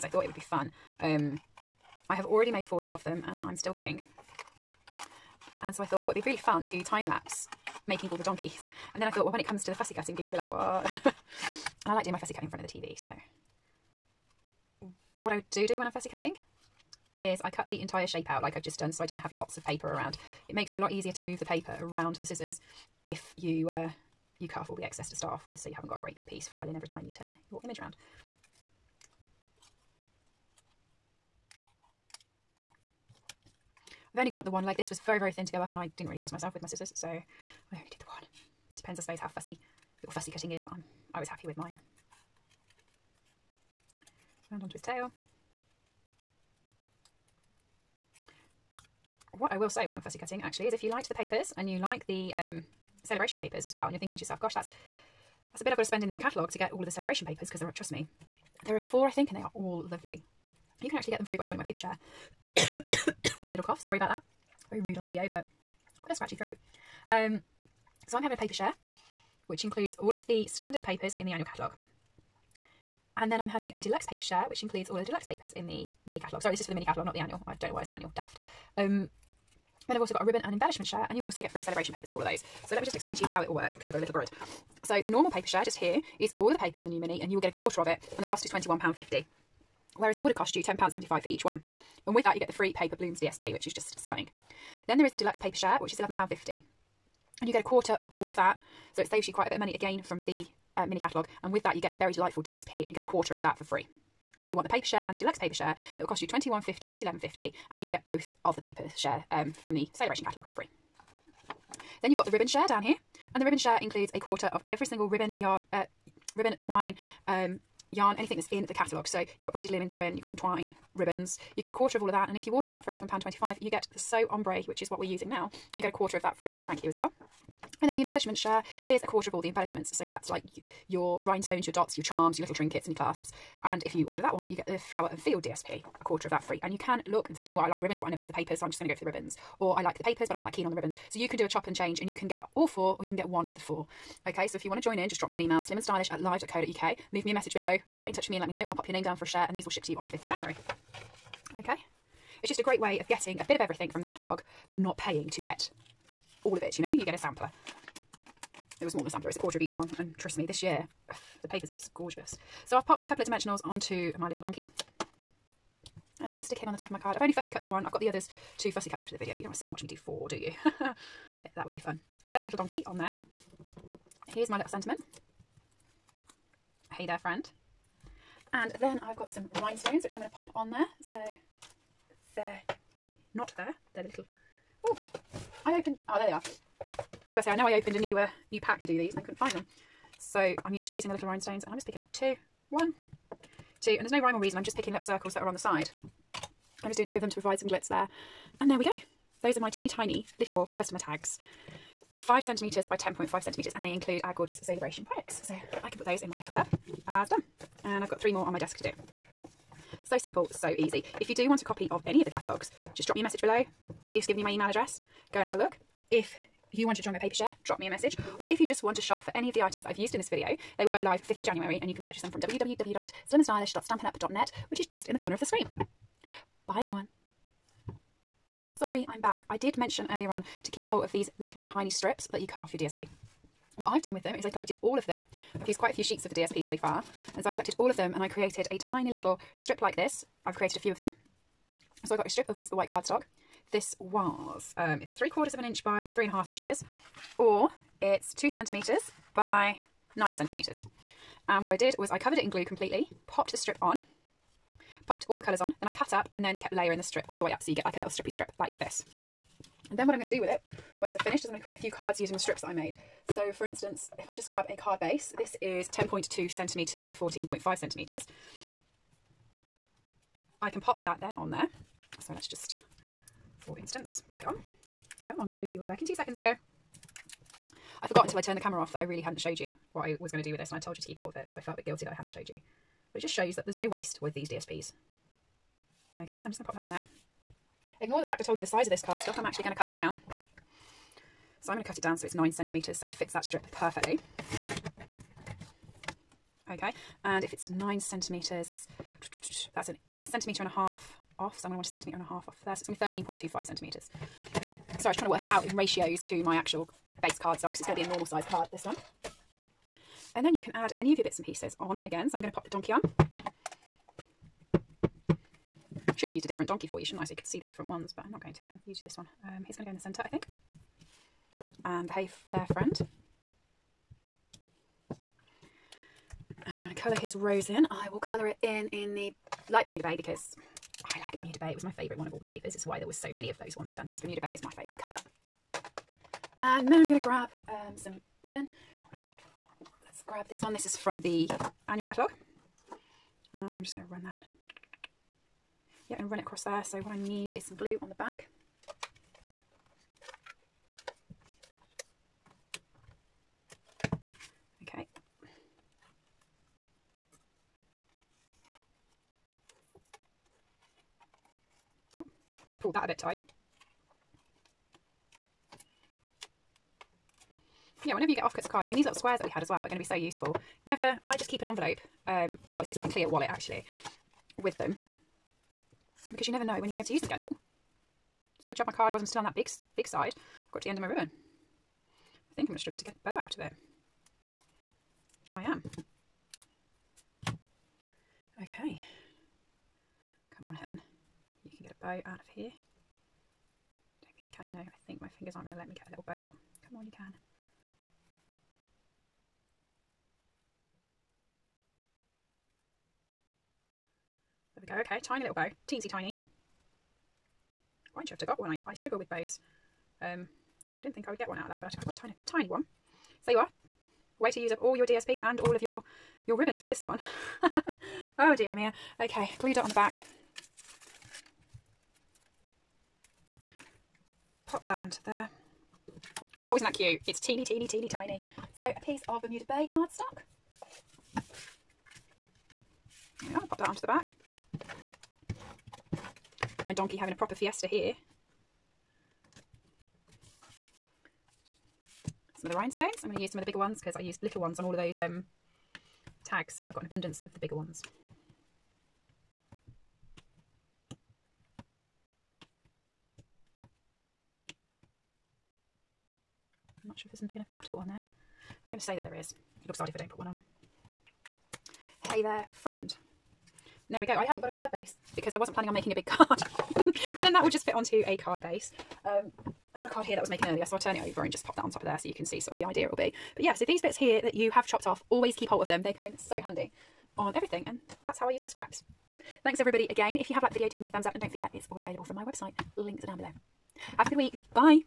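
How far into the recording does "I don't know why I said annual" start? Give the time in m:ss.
1:17.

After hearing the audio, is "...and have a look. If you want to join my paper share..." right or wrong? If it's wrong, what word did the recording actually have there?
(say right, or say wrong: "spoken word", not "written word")
right.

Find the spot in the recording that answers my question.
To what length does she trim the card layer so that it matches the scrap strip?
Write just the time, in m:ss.
5:03.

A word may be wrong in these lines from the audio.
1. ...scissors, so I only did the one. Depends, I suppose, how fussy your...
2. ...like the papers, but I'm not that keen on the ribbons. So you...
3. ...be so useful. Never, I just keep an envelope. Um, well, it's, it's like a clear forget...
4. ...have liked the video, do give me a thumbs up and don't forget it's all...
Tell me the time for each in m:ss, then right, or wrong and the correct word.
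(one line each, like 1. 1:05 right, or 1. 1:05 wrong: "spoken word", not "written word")
1. 0:36 right
2. 2:19 right
3. 6:09 wrong: "wallet", not "forget"
4. 8:00 right.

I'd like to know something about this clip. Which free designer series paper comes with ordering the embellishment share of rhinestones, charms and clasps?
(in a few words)
Flower and Field.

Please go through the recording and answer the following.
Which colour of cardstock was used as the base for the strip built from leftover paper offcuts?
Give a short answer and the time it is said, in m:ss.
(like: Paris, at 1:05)
Whisper White, at 4:02.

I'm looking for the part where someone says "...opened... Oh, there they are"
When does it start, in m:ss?
3:05.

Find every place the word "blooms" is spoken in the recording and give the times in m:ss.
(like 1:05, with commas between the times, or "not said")
1:32.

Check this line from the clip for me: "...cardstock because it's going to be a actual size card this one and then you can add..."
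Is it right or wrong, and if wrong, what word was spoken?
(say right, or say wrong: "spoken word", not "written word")
wrong: "normal", not "actual".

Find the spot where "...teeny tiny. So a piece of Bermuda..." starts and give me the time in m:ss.
7:07.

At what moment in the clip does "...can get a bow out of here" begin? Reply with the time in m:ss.
6:31.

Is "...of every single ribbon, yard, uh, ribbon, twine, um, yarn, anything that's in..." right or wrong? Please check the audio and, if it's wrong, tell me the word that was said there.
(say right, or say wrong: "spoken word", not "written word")
right.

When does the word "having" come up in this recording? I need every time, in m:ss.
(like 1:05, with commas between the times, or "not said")
1:08, 1:13, 7:17.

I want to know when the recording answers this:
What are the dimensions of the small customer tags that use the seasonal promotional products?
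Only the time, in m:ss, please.
3:22.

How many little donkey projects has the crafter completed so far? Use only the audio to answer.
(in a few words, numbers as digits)
40.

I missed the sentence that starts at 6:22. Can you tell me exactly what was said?
I think I'm going to struggle to get a bow out of it.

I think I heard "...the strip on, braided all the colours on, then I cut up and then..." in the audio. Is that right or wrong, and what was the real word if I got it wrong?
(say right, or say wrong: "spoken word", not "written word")
wrong: "popped", not "braided".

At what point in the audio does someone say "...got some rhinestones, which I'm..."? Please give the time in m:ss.
2:59.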